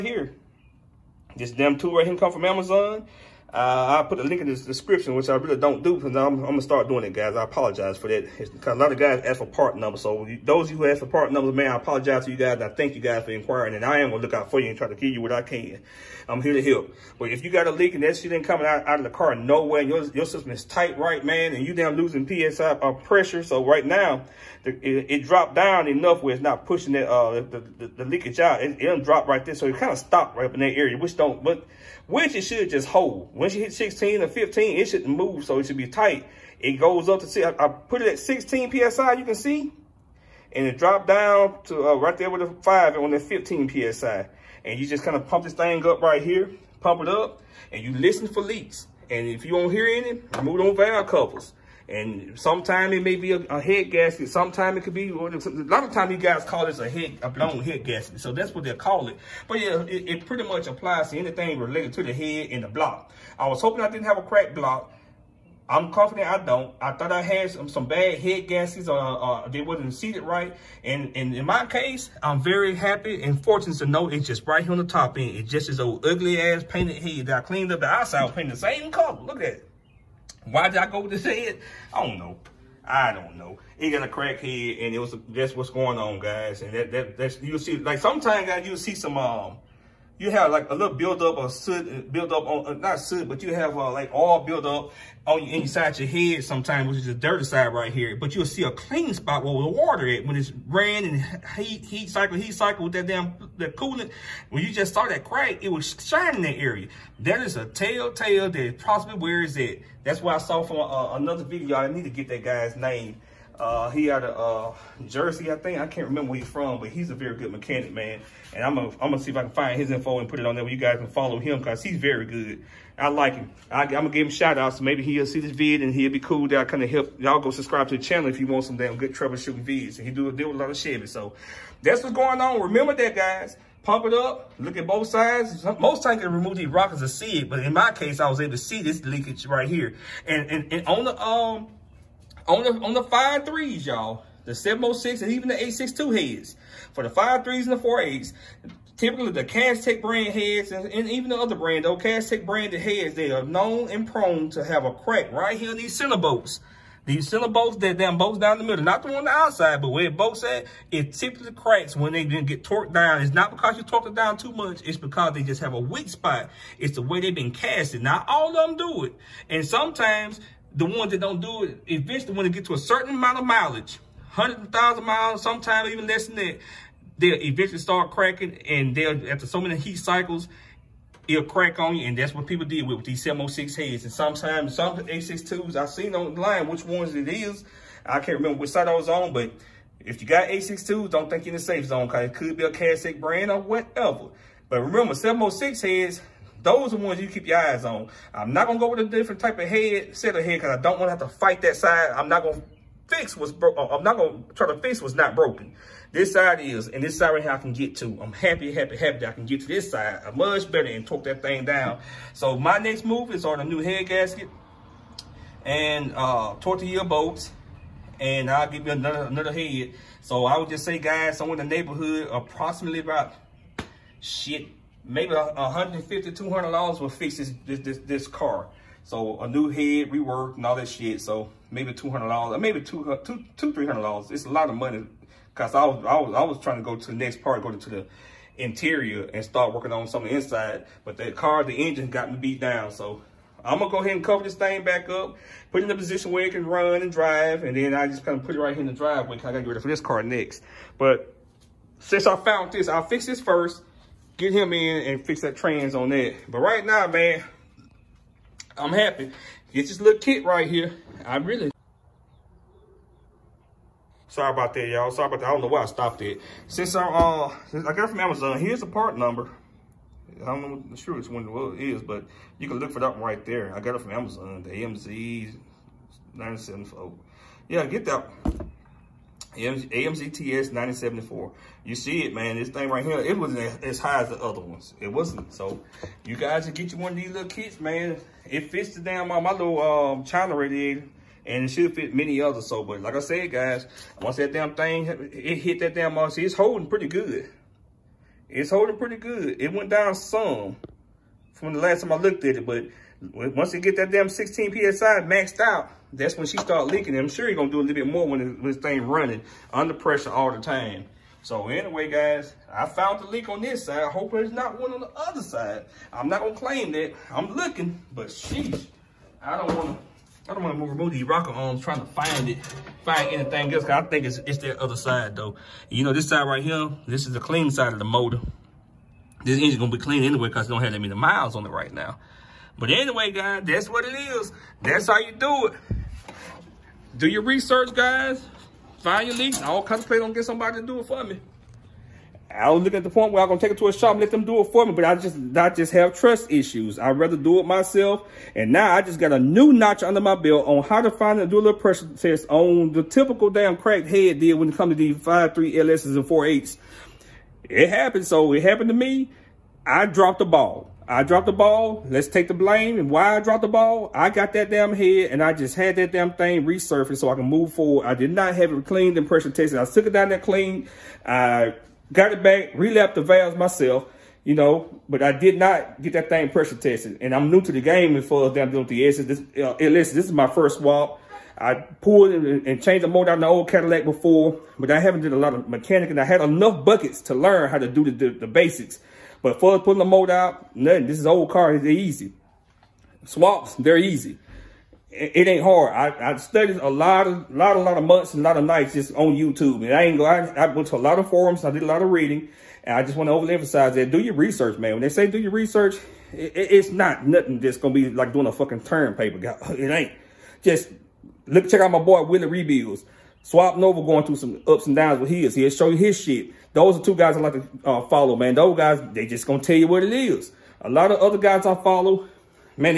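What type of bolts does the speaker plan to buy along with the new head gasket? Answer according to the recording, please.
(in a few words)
Torque to yield bolts.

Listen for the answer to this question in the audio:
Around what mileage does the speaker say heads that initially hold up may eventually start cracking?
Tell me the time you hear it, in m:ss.
2:54.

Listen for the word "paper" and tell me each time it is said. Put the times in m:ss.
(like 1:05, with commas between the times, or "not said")
6:49.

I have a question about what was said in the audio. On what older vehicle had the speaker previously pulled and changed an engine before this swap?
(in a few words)
Cadillac.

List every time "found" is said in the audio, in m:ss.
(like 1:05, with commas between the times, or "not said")
4:12, 5:12.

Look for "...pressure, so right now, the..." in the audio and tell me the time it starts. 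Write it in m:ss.
0:22.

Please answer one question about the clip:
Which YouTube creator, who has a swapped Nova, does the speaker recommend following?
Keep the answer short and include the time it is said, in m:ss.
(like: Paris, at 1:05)
Willie Rebuilds, at 6:52.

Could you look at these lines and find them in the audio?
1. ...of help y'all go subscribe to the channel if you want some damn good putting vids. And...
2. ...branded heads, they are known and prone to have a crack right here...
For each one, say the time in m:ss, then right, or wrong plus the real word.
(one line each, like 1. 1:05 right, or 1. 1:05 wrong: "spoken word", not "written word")
1. 2:06 wrong: "troubleshooting", not "putting"
2. 2:32 right.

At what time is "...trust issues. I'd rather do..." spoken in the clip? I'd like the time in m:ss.
5:46.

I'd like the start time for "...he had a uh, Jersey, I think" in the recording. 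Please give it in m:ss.
1:53.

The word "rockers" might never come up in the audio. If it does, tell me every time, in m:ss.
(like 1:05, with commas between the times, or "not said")
2:16, 5:21.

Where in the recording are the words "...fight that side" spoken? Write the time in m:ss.
3:21.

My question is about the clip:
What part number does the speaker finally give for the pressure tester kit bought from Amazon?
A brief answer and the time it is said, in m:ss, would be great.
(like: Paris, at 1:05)
AMZTS 974, at 4:39.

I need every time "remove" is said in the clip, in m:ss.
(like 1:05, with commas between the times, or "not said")
2:16, 5:20.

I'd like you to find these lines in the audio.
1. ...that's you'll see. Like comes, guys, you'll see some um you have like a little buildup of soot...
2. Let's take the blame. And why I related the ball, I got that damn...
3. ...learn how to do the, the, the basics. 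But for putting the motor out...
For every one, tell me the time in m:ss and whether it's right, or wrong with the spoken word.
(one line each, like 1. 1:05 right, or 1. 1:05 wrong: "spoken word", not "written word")
1. 1:27 wrong: "sometimes", not "comes"
2. 6:02 wrong: "dropped", not "related"
3. 6:27 right.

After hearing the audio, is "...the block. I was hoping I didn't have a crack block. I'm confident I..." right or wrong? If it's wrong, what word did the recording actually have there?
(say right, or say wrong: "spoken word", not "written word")
right.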